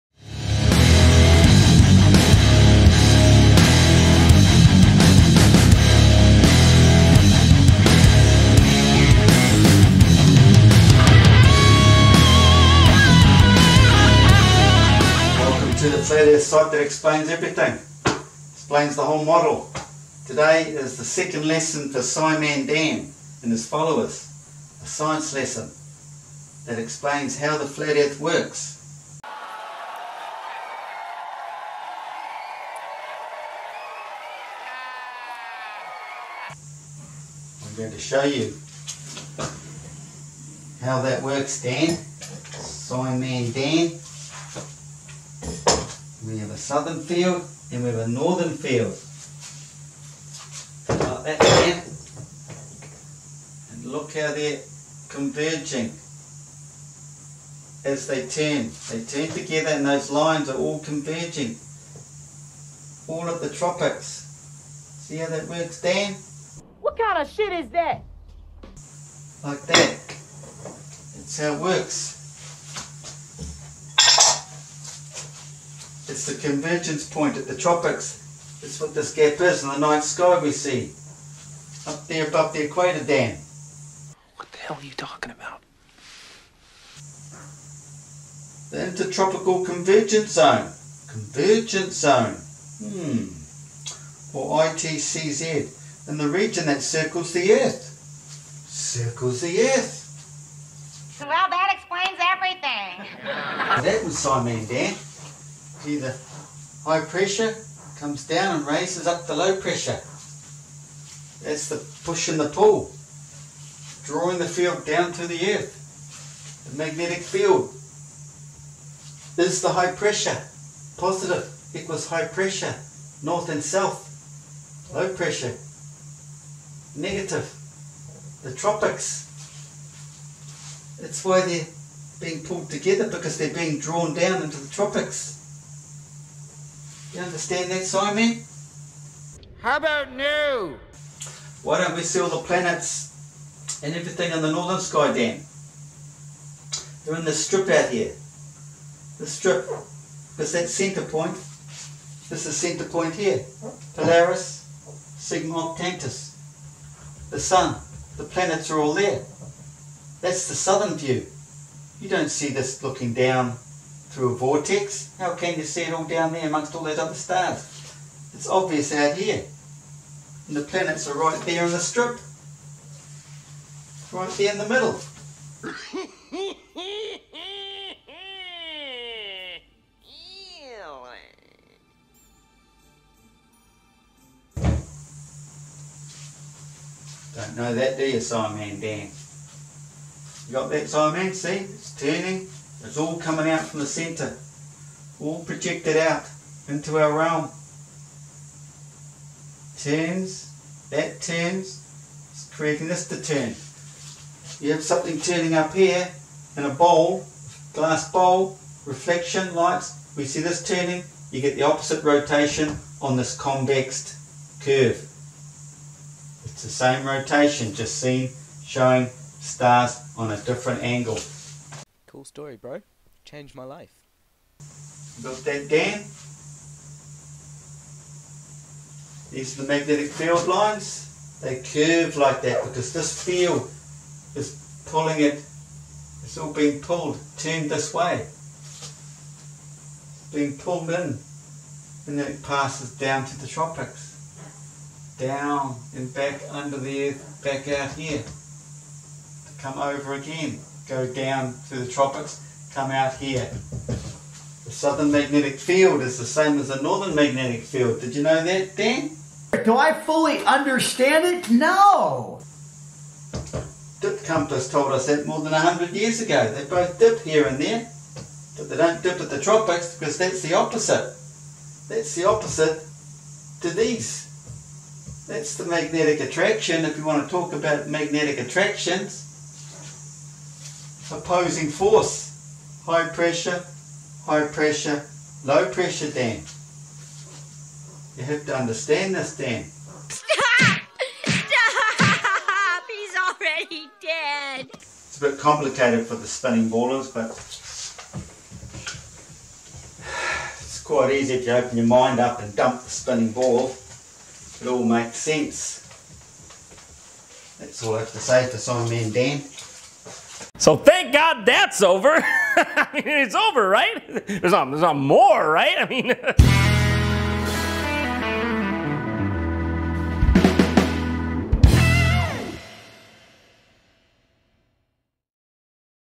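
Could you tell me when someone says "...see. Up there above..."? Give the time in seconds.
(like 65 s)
80 s.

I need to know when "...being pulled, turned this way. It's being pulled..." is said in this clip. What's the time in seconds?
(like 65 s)
236 s.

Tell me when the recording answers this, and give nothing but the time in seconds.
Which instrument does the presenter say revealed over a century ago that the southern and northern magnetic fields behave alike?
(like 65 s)
264 s.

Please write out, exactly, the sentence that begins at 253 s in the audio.
The southern magnetic field is the same as the northern magnetic field.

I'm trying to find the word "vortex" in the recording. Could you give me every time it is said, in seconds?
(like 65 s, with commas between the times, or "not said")
164 s.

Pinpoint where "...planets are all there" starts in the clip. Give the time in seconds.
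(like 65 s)
158 s.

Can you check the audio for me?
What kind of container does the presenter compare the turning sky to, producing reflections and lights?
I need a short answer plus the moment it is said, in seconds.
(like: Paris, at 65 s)
glass bowl, at 207 s.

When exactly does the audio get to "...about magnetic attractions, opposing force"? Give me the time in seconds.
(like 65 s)
277 s.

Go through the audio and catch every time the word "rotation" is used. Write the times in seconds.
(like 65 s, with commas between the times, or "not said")
212 s, 217 s.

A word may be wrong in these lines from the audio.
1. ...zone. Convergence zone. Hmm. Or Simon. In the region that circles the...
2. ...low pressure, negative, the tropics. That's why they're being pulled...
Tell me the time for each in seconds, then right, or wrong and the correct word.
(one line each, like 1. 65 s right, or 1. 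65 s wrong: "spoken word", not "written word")
1. 90 s wrong: "ITCZ", not "Simon"
2. 124 s right.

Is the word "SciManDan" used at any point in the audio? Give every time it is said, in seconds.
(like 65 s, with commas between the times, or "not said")
21 s, 41 s, 104 s, 188 s, 308 s.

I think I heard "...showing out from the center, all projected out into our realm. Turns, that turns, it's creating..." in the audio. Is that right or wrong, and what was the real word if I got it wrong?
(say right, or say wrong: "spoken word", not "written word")
wrong: "coming", not "showing".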